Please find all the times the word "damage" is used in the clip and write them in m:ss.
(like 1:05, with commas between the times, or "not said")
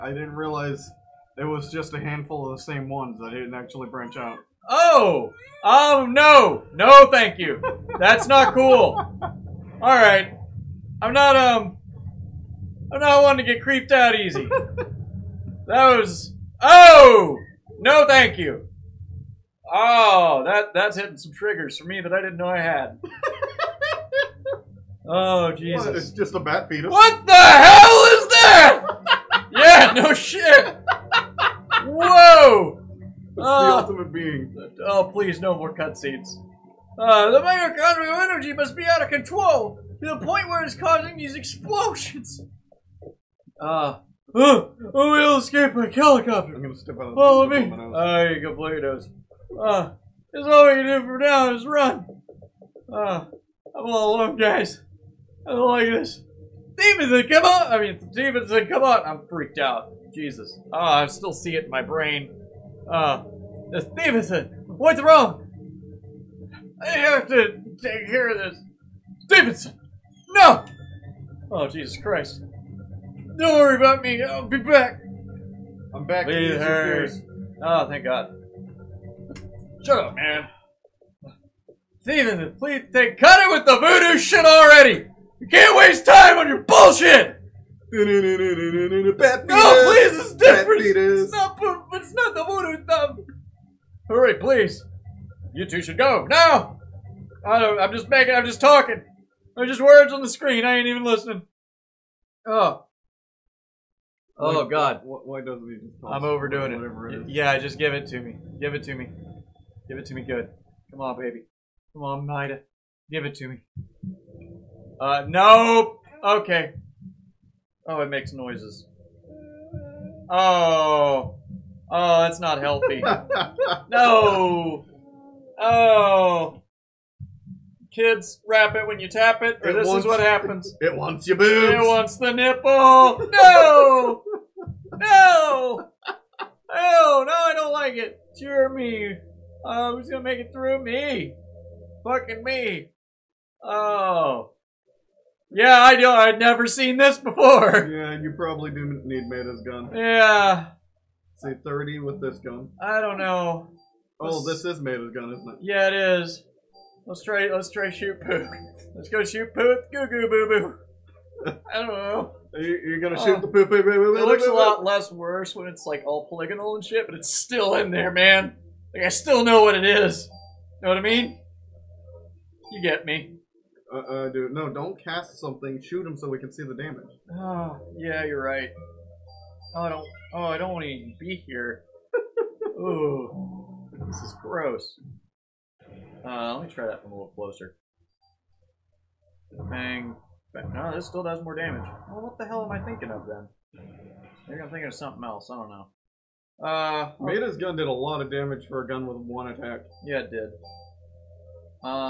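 2:56, 3:11, 3:18.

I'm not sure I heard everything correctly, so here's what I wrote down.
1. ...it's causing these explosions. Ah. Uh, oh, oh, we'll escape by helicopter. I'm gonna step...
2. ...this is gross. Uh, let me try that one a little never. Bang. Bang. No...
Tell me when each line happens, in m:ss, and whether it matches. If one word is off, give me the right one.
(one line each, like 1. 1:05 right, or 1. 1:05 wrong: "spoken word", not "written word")
1. 0:40 right
2. 3:04 wrong: "closer", not "never".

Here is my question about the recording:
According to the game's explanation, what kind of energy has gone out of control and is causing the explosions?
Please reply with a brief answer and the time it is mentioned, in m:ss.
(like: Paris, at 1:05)
mitochondrial energy, at 0:37.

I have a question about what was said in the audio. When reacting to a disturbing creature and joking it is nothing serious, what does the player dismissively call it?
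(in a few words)
bat fetus.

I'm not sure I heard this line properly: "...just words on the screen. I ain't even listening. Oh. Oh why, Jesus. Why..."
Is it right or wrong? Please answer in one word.
wrong.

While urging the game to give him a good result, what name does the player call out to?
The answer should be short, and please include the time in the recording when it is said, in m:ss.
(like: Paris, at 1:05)
Nida, at 1:52.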